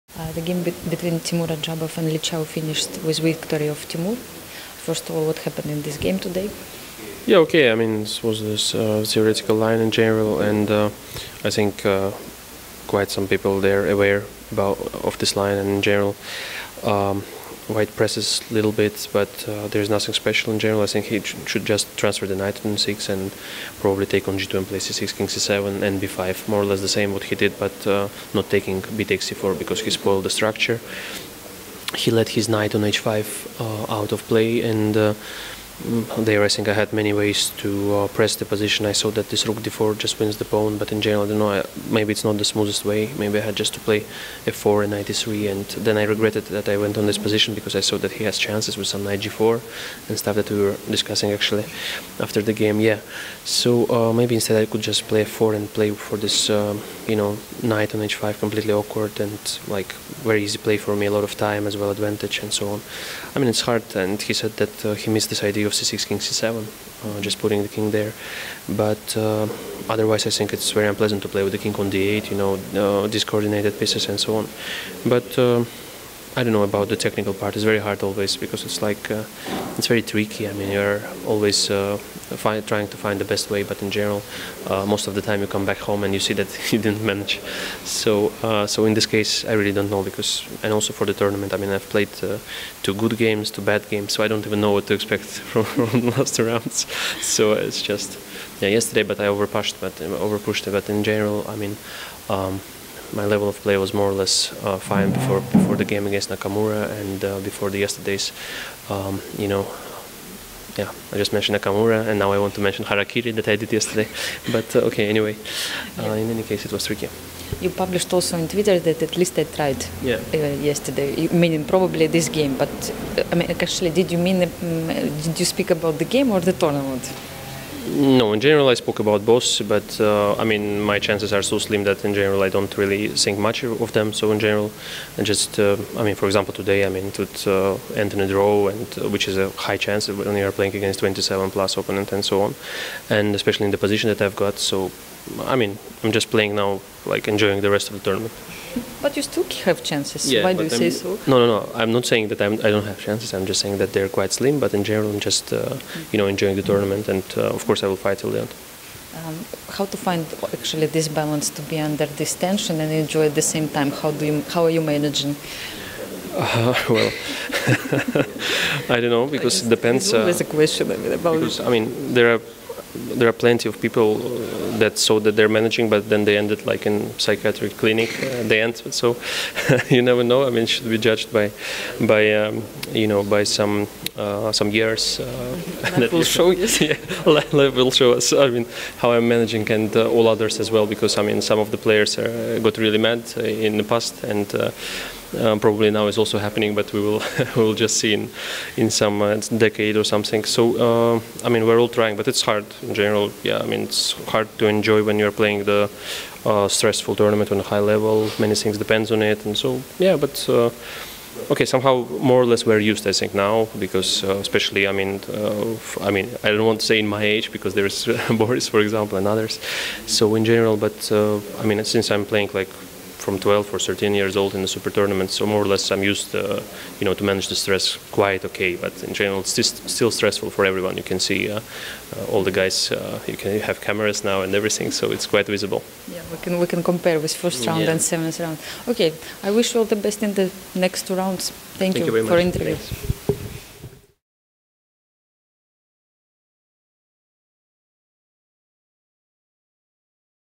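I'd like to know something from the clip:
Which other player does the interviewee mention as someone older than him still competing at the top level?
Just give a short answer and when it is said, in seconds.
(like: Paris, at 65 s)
Boris, at 218 s.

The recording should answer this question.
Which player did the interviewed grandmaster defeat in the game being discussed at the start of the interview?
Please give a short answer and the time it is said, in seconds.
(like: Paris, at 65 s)
Li Chao, at 2 s.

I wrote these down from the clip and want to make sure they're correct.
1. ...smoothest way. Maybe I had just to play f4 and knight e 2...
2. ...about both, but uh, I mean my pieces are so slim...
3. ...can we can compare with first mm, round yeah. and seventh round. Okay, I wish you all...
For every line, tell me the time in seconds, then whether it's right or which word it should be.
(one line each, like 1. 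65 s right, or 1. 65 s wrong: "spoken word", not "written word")
1. 42 s wrong: "3", not "2"
2. 128 s wrong: "chances", not "pieces"
3. 236 s right.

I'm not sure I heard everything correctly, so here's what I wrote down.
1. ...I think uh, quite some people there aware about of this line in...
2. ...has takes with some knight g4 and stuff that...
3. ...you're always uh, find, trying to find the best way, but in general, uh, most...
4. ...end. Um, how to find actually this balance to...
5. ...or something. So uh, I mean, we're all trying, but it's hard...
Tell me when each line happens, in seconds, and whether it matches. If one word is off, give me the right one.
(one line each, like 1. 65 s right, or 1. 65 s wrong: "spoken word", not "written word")
1. 11 s right
2. 48 s wrong: "chances", not "takes"
3. 80 s right
4. 158 s right
5. 199 s right.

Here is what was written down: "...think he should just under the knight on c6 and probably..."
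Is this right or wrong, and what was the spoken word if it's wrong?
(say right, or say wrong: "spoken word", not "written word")
wrong: "transfer", not "under".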